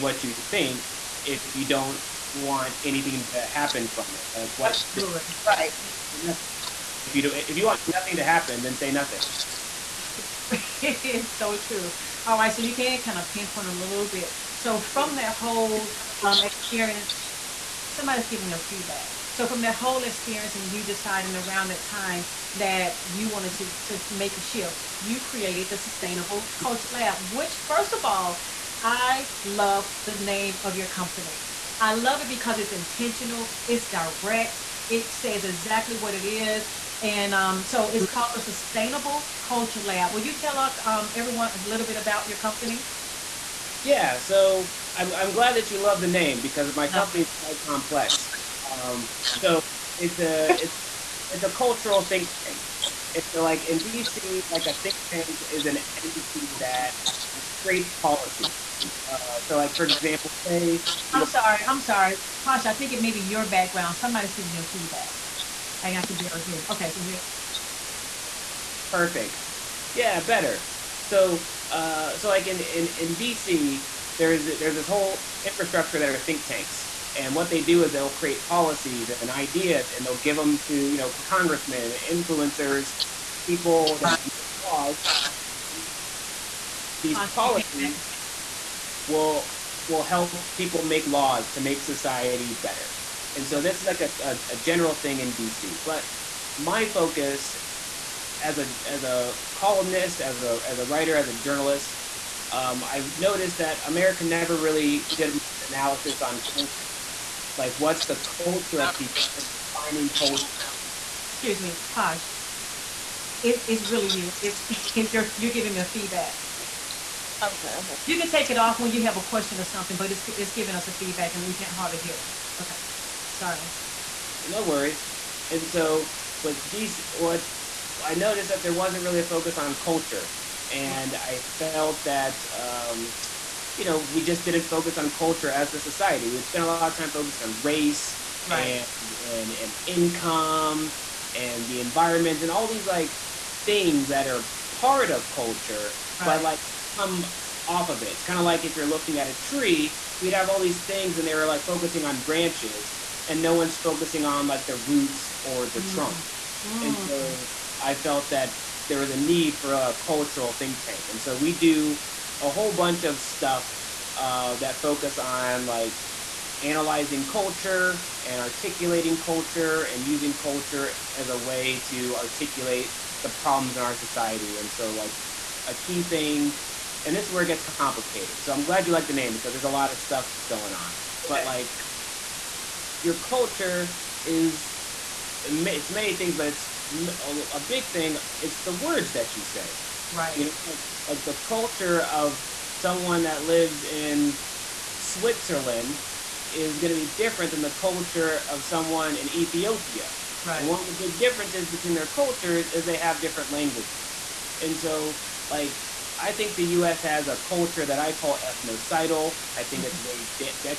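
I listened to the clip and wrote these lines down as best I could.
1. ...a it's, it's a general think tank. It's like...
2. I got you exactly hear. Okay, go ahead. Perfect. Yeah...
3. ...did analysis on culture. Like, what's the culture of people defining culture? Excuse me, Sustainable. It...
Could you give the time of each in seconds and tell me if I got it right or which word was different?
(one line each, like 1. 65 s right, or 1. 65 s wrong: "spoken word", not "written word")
1. 50 s wrong: "cultural", not "general"
2. 65 s wrong: "barely", not "exactly"
3. 105 s wrong: "Posh", not "Sustainable".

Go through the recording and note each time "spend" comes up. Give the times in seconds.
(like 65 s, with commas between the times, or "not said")
136 s.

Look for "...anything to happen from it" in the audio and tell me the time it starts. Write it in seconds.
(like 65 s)
2 s.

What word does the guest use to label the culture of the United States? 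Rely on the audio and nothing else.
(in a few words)
ethnocidal.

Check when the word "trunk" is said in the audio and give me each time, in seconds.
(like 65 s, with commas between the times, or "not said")
155 s.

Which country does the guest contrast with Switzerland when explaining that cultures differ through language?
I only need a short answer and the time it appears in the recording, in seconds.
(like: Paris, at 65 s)
Ethiopia, at 199 s.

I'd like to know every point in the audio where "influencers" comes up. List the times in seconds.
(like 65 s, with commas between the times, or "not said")
82 s.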